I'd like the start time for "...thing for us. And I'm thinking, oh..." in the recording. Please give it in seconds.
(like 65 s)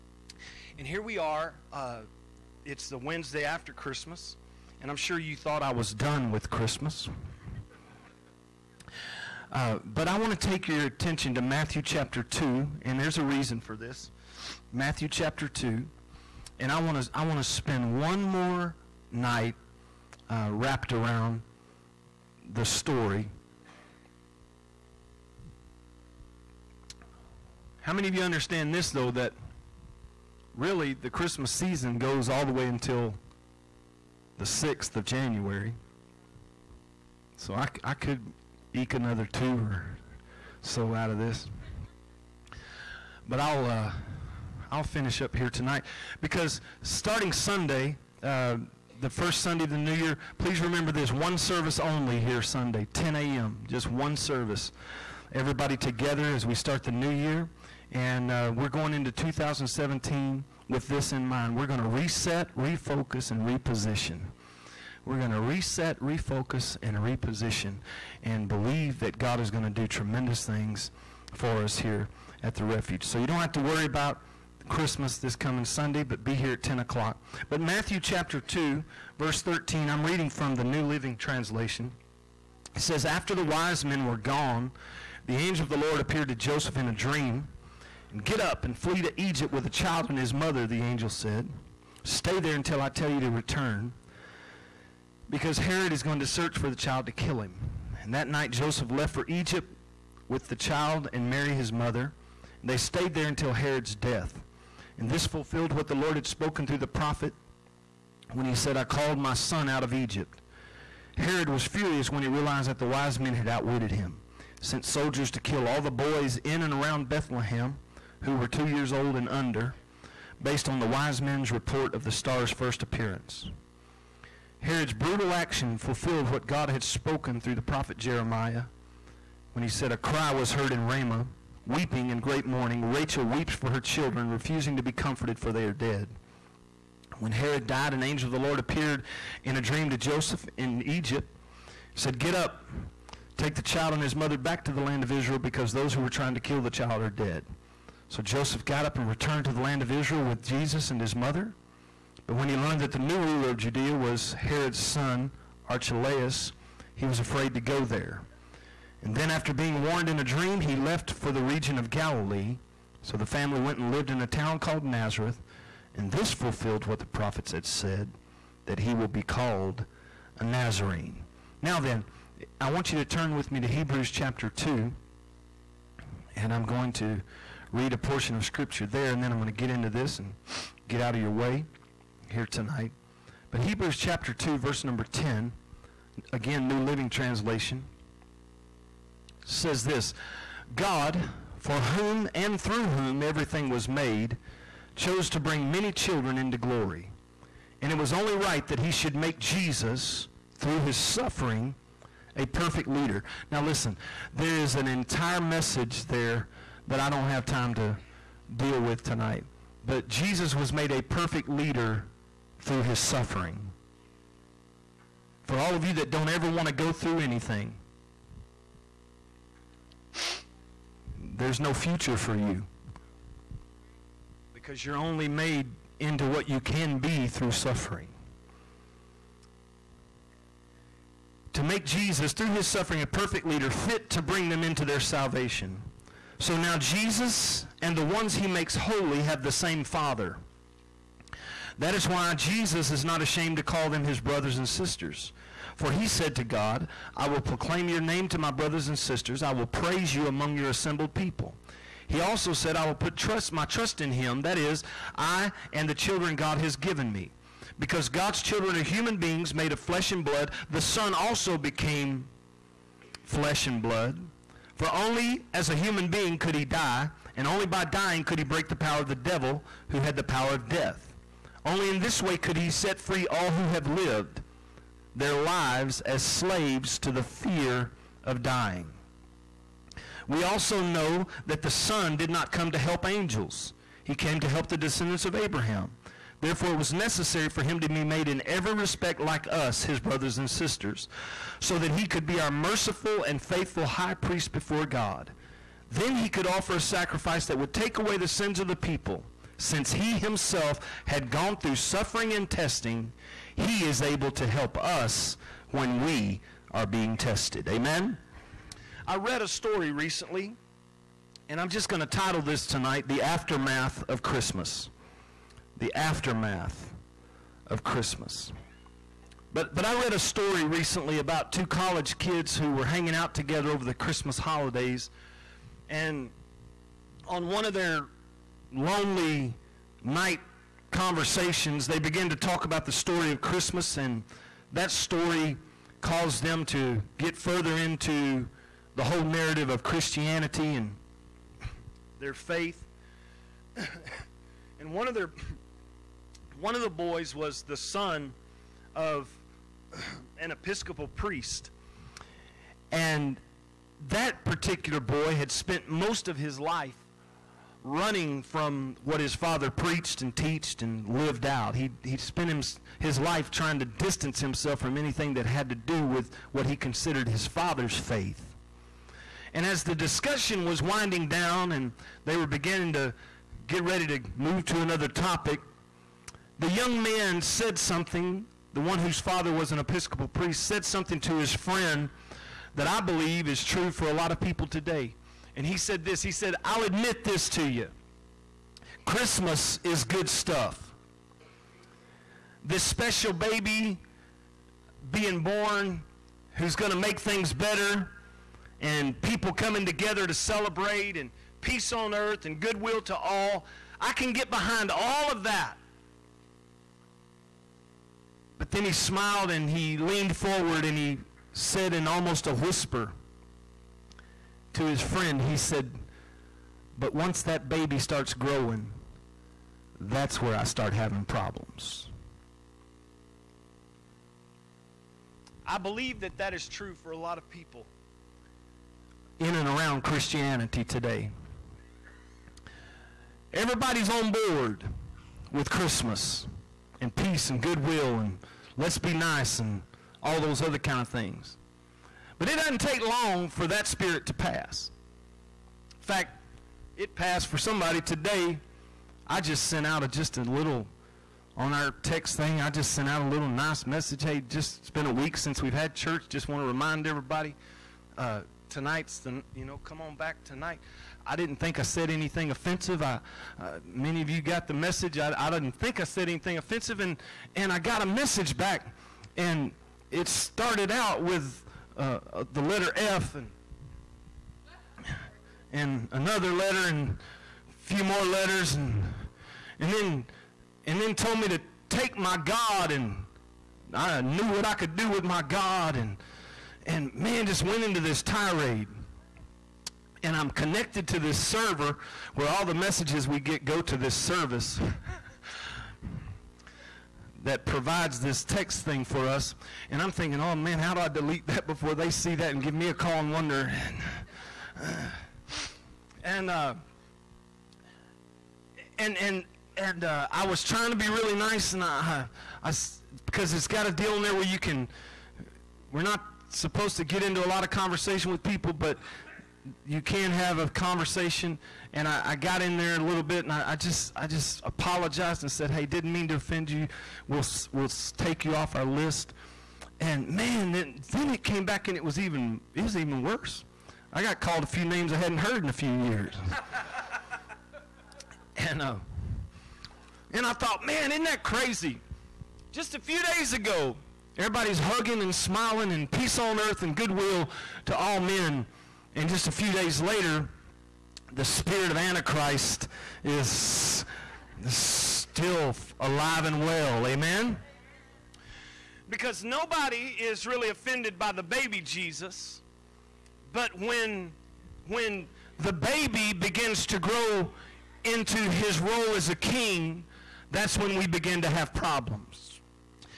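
498 s.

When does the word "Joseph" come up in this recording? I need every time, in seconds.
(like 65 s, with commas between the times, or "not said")
86 s, 98 s, 139 s, 148 s.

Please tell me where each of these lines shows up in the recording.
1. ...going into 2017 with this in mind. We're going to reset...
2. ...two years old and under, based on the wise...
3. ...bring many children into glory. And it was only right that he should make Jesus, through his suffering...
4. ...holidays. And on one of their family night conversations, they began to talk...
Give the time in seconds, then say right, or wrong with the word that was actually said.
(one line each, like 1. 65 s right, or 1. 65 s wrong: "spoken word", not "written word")
1. 58 s right
2. 118 s right
3. 195 s right
4. 324 s wrong: "lonely", not "family".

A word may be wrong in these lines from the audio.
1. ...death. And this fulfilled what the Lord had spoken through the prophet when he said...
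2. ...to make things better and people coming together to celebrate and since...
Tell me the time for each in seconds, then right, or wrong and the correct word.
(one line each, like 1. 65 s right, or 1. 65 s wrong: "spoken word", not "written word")
1. 103 s right
2. 396 s wrong: "peace", not "since".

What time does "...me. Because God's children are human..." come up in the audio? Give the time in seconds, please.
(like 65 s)
257 s.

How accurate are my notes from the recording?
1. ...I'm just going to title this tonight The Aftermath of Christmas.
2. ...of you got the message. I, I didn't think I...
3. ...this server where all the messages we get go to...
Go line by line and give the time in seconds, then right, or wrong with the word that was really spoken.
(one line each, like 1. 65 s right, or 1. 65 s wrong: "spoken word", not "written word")
1. 311 s right
2. 464 s right
3. 491 s right.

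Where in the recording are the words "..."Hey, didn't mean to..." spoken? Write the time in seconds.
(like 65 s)
525 s.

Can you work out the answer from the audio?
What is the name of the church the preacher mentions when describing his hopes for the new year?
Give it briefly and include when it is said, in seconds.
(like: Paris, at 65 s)
the refuge, at 72 s.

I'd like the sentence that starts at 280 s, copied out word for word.
We also know that the Son did not come to help angels, he came to help the descendants of Abraham.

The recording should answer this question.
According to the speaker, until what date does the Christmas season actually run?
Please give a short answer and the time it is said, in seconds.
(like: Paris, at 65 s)
6th of January, at 34 s.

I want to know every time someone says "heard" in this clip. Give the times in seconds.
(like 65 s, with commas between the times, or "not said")
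130 s, 535 s.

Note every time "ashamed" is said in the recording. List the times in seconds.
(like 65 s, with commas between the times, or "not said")
243 s.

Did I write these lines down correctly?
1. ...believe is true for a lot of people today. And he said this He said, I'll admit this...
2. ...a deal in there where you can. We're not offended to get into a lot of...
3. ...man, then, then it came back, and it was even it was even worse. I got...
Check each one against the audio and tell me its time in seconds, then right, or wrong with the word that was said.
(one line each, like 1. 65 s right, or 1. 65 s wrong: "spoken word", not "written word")
1. 383 s right
2. 513 s wrong: "supposed", not "offended"
3. 530 s right.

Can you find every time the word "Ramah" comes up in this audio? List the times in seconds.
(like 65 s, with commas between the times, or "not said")
130 s.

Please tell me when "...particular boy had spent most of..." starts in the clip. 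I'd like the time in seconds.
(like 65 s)
354 s.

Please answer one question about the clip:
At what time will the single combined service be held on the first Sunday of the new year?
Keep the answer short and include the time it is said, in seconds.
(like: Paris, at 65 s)
10 a.m., at 52 s.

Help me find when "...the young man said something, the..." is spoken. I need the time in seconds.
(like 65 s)
376 s.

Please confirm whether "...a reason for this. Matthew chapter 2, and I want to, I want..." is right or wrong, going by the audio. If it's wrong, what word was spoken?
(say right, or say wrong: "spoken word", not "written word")
right.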